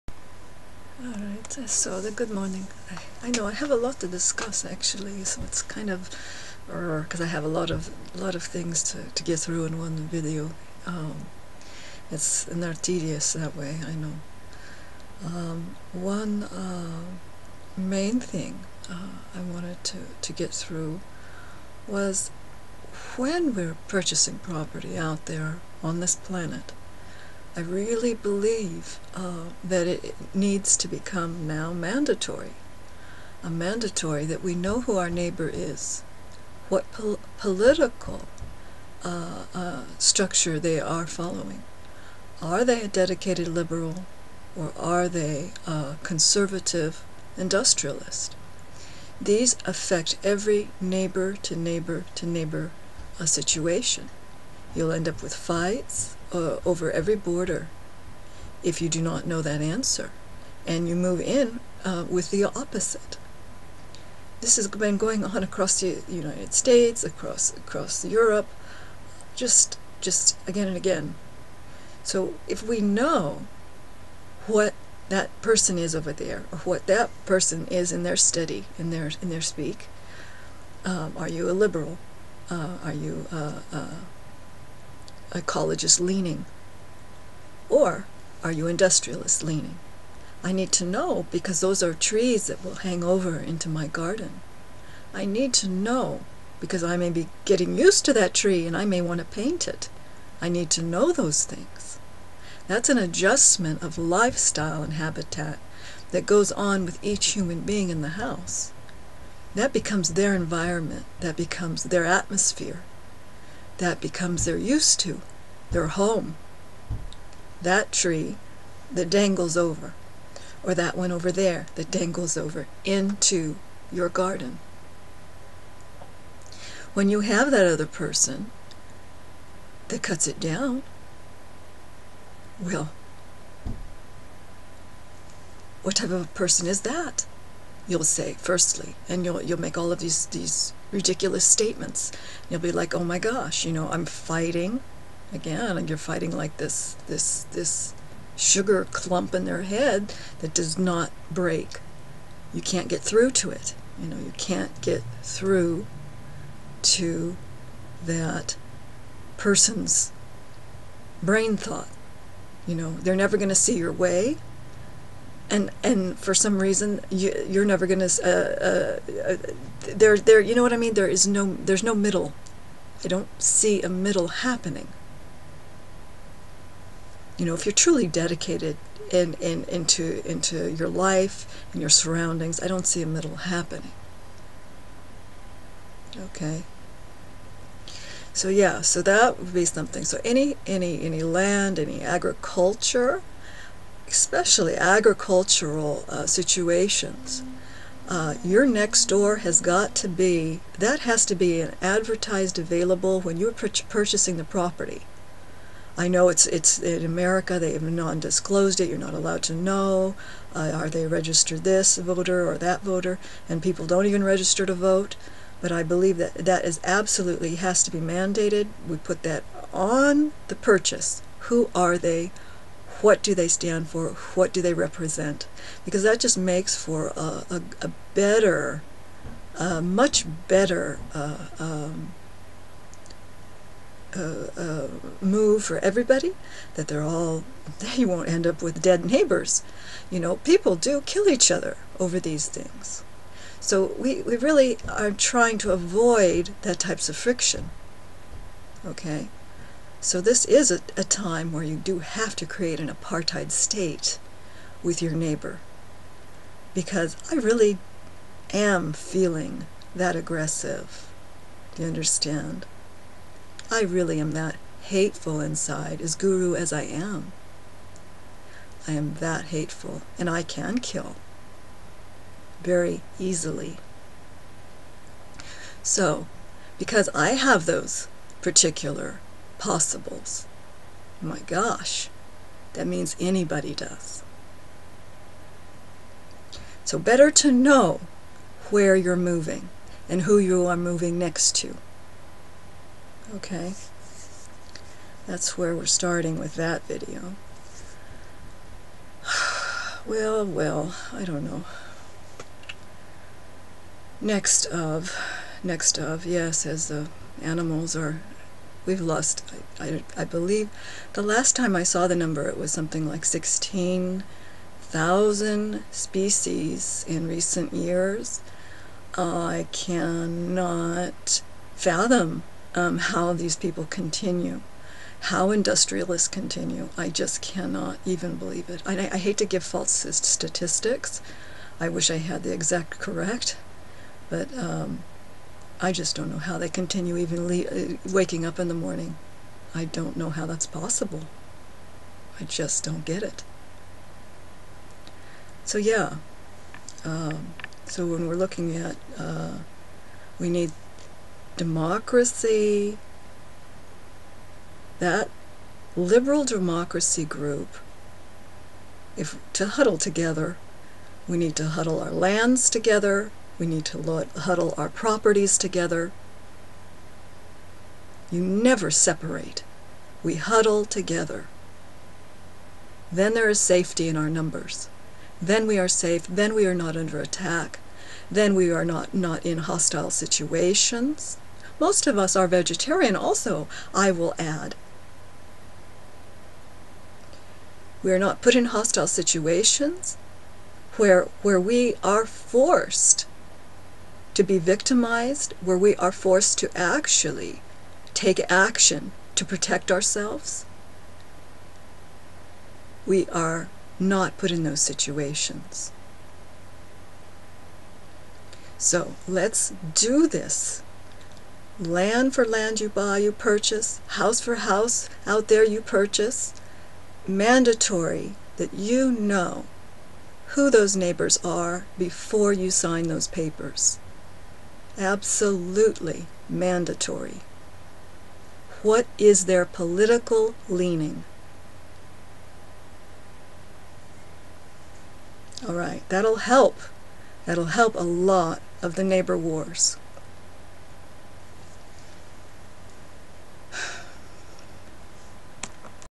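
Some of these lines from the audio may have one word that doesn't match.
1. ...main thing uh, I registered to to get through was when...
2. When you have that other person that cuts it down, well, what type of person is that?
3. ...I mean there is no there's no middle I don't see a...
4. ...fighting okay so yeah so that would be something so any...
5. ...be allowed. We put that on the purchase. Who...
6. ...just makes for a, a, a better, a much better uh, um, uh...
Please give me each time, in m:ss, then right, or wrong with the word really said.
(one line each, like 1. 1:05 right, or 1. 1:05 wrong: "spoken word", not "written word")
1. 0:17 wrong: "wanted", not "registered"
2. 2:06 right
3. 2:50 right
4. 3:03 wrong: "happening", not "fighting"
5. 3:37 wrong: "mandated", not "allowed"
6. 3:46 right.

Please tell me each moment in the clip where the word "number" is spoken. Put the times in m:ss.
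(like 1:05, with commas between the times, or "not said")
5:12, 6:14.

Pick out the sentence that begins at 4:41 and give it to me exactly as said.
My gosh, that means anybody does.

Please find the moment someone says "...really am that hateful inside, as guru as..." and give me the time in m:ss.
4:23.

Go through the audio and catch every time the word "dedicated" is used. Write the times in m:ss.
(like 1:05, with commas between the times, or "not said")
0:42, 2:58.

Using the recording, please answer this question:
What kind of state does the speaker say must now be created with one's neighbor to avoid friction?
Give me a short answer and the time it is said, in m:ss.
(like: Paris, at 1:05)
apartheid state, at 4:12.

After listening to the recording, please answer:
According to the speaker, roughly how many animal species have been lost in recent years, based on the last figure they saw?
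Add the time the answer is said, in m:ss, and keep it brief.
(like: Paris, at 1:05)
16,000, at 5:13.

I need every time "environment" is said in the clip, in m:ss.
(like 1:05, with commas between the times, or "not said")
1:50.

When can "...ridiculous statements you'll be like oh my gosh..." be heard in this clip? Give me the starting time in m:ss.
2:20.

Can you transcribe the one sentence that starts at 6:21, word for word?
Most of us are vegetarian, also, I will add.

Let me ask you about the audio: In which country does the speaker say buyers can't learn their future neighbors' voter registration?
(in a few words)
America.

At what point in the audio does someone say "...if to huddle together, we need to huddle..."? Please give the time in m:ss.
5:59.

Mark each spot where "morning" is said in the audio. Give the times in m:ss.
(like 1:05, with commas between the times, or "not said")
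0:02, 5:38.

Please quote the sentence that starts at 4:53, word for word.
Okay, that's where we're starting with that video.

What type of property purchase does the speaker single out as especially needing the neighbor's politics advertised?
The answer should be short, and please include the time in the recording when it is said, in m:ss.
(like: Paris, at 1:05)
agricultural, at 3:14.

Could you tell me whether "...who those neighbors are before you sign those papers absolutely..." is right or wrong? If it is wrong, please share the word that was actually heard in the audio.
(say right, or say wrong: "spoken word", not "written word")
right.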